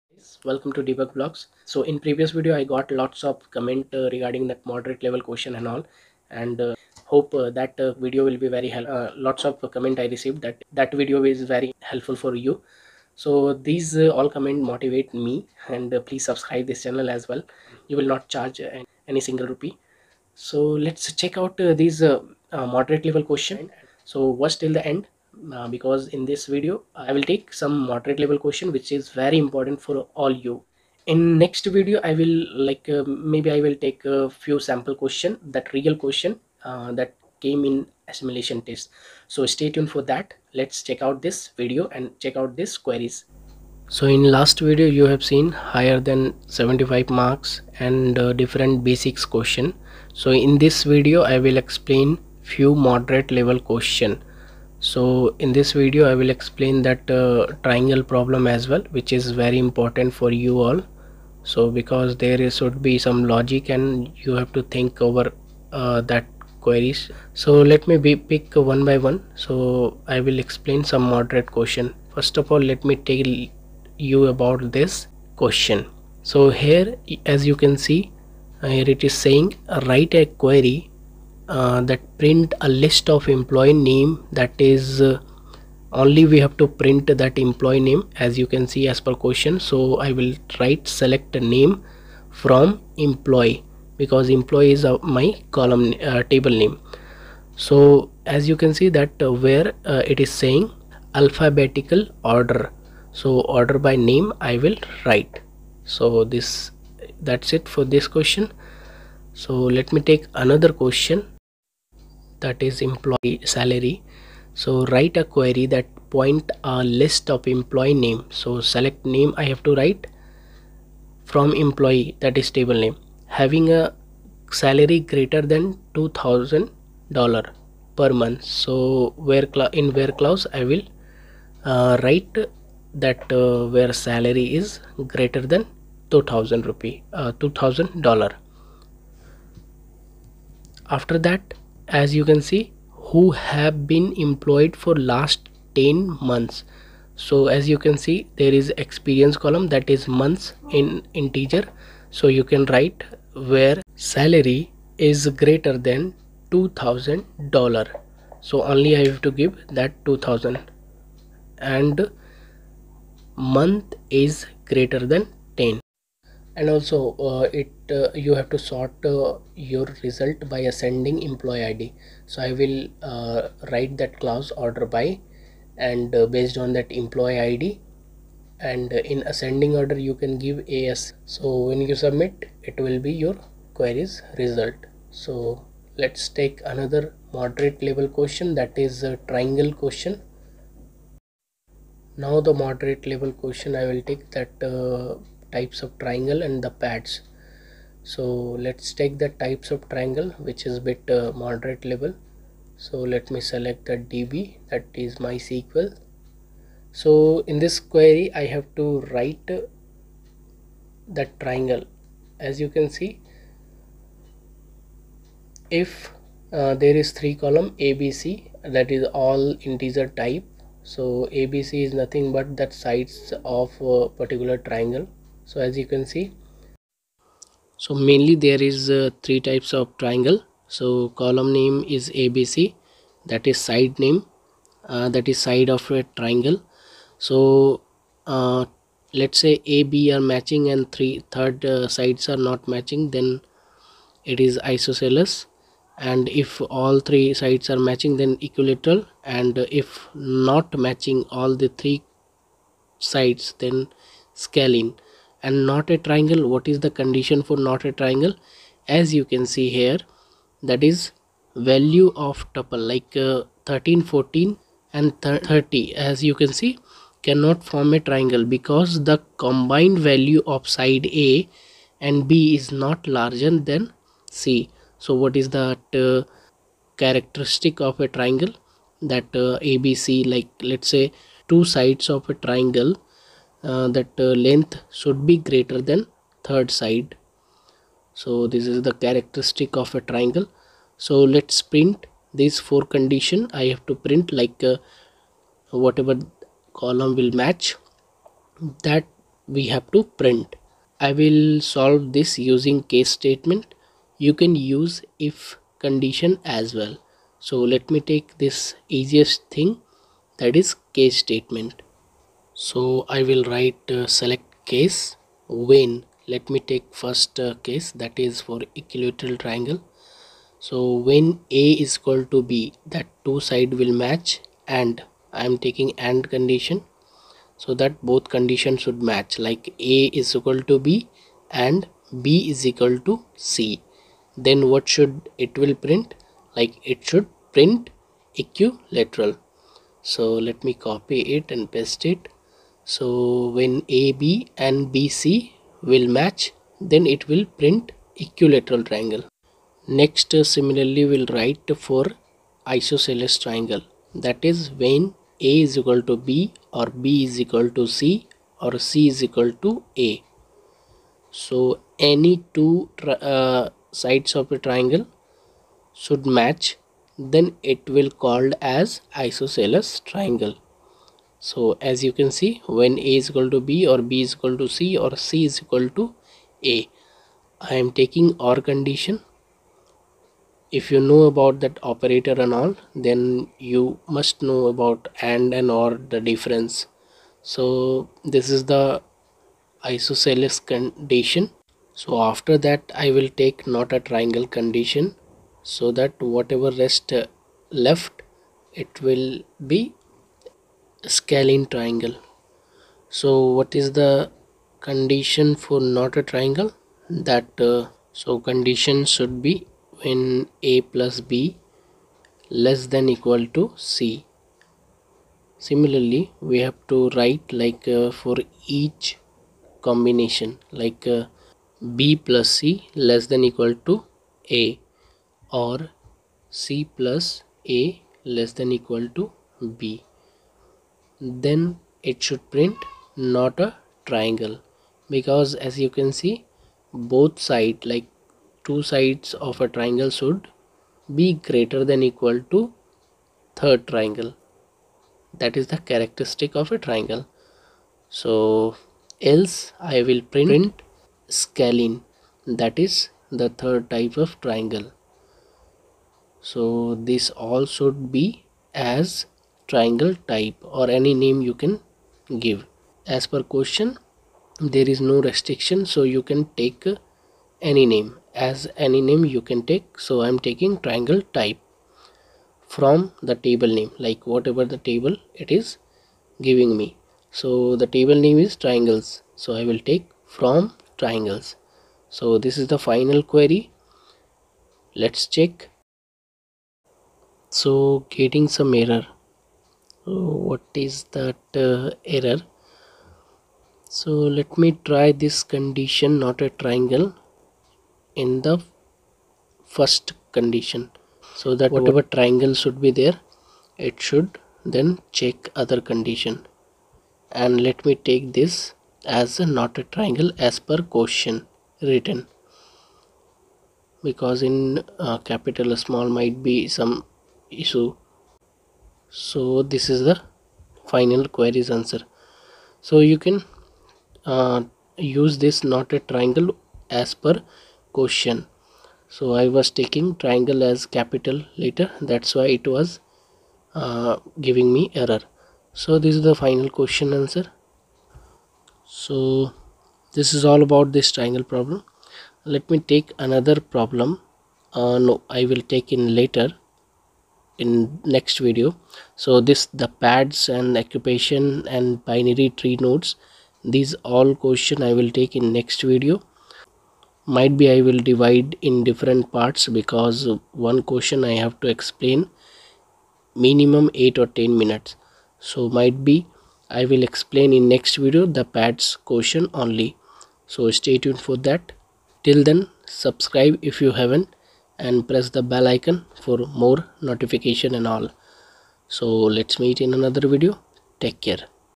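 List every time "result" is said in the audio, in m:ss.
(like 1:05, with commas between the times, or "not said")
2:50, 3:04.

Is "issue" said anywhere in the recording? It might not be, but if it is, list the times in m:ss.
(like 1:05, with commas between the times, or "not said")
8:37.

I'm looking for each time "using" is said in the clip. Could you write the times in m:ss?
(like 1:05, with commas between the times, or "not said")
5:02.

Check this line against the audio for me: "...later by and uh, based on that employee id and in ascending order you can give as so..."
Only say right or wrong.
wrong.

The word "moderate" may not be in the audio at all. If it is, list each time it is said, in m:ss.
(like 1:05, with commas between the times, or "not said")
0:04, 0:22, 0:27, 0:52, 1:11, 3:07, 3:12, 3:21.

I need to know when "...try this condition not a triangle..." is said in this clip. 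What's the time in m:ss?
8:14.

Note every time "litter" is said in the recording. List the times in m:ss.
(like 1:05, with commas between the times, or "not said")
not said.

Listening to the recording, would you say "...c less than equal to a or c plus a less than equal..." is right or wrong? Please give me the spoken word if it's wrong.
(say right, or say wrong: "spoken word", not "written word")
right.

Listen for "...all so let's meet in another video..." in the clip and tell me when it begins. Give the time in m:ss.
9:37.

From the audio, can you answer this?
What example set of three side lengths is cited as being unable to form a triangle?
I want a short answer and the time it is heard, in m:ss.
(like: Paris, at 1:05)
13, 14 and 30, at 4:23.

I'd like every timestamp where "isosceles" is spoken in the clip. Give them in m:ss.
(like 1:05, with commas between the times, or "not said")
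4:04, 5:52, 6:09, 6:29.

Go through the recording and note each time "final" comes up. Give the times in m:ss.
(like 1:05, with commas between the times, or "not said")
8:02, 8:40, 8:56.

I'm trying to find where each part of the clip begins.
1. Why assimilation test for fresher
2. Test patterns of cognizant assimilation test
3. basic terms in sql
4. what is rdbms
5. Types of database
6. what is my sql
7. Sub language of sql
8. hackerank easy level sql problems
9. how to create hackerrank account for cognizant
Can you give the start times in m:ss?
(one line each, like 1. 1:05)
1. 0:48
2. 1:30
3. 1:45
4. 2:00
5. 2:55
6. 3:35
7. 4:00
8. 4:45
9. 5:40.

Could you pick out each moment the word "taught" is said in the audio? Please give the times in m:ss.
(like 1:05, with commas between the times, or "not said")
not said.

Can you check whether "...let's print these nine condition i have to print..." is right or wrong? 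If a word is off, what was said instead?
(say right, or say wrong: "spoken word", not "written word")
wrong: "four", not "nine".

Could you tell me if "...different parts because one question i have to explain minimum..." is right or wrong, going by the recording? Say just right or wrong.
right.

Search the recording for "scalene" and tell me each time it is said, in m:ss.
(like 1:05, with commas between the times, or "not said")
4:14, 6:41, 7:31.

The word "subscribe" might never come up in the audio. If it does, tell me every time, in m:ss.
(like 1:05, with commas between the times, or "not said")
0:16, 9:32.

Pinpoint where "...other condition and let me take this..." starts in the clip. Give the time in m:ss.
8:25.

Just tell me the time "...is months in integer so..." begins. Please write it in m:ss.
2:29.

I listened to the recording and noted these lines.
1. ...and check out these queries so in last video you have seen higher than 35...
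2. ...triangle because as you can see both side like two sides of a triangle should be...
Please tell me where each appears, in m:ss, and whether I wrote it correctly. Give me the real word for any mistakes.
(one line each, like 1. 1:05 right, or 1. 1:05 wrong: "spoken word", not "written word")
1. 0:41 wrong: "75", not "35"
2. 7:14 right.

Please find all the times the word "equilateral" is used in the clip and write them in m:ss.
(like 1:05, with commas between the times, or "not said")
4:08, 5:18, 5:38, 5:48.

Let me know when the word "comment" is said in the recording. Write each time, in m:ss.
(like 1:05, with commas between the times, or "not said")
0:03, 0:09, 0:14.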